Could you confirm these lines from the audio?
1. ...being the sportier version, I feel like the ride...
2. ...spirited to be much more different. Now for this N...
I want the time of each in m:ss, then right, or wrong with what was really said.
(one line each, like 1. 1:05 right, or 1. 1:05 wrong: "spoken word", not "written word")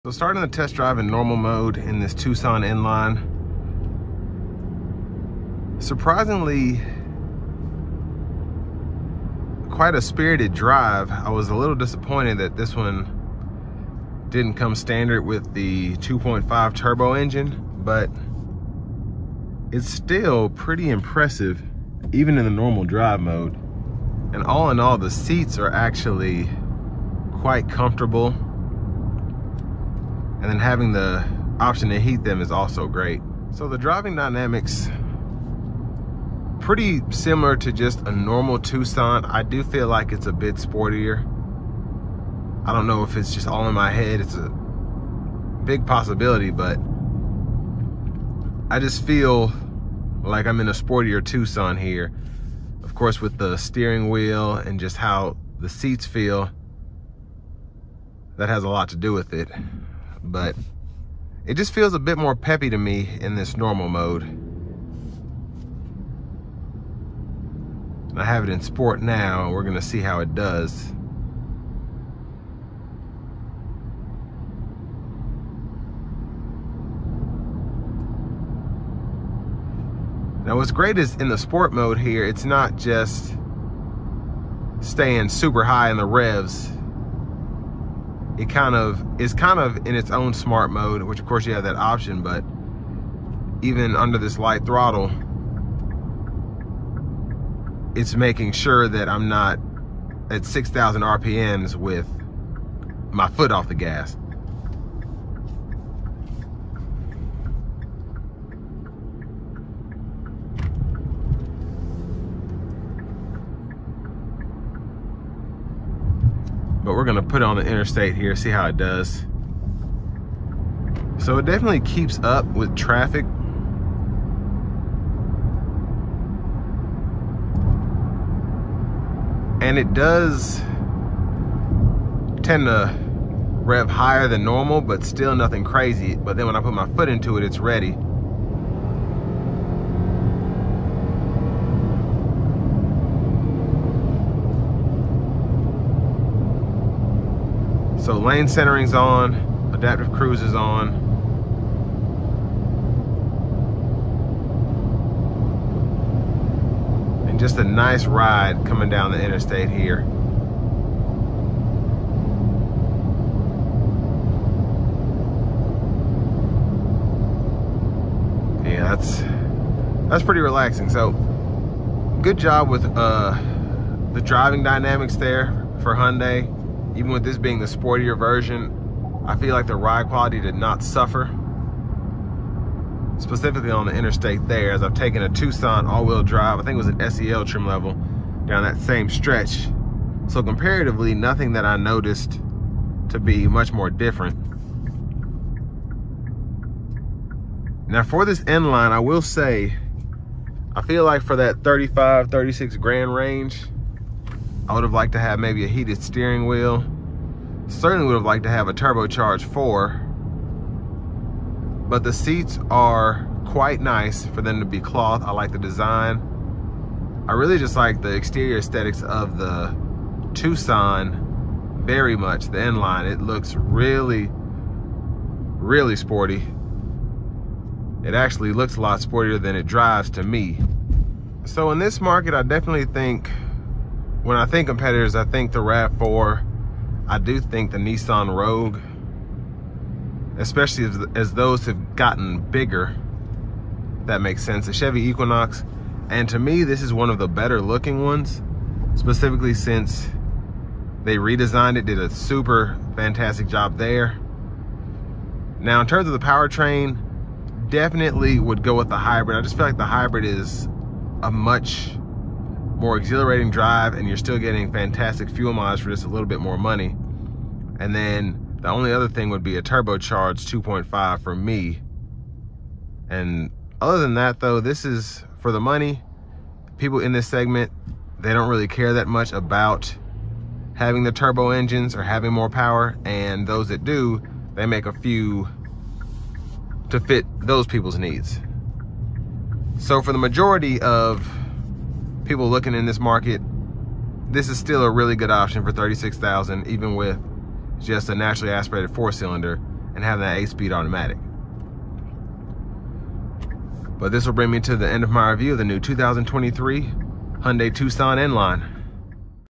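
1. 2:57 right
2. 3:11 wrong: "noticed", not "spirited".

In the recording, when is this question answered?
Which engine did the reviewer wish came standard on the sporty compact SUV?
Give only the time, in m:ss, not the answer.
0:15.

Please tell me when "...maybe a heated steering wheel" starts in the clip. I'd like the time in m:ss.
3:25.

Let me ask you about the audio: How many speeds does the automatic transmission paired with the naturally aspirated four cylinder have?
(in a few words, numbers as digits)
8.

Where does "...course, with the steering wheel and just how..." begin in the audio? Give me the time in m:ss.
0:52.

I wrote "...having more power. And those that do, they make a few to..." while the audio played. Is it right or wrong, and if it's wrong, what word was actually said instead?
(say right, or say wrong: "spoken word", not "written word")
right.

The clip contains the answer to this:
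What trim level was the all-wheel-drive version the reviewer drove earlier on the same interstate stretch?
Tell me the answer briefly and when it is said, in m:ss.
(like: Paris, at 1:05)
SEL, at 3:07.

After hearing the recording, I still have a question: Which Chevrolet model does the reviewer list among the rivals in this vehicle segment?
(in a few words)
Equinox.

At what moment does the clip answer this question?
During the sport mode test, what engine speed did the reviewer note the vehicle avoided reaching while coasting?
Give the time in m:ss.
1:40.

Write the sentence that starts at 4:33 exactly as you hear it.
And other than that though, this is for the money.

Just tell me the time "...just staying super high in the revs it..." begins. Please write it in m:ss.
1:22.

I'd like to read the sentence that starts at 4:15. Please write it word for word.
Now, in terms of the powertrain, definitely would go with the hybrid.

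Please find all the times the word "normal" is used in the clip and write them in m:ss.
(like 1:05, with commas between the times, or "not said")
0:01, 0:22, 0:38, 1:03, 2:14.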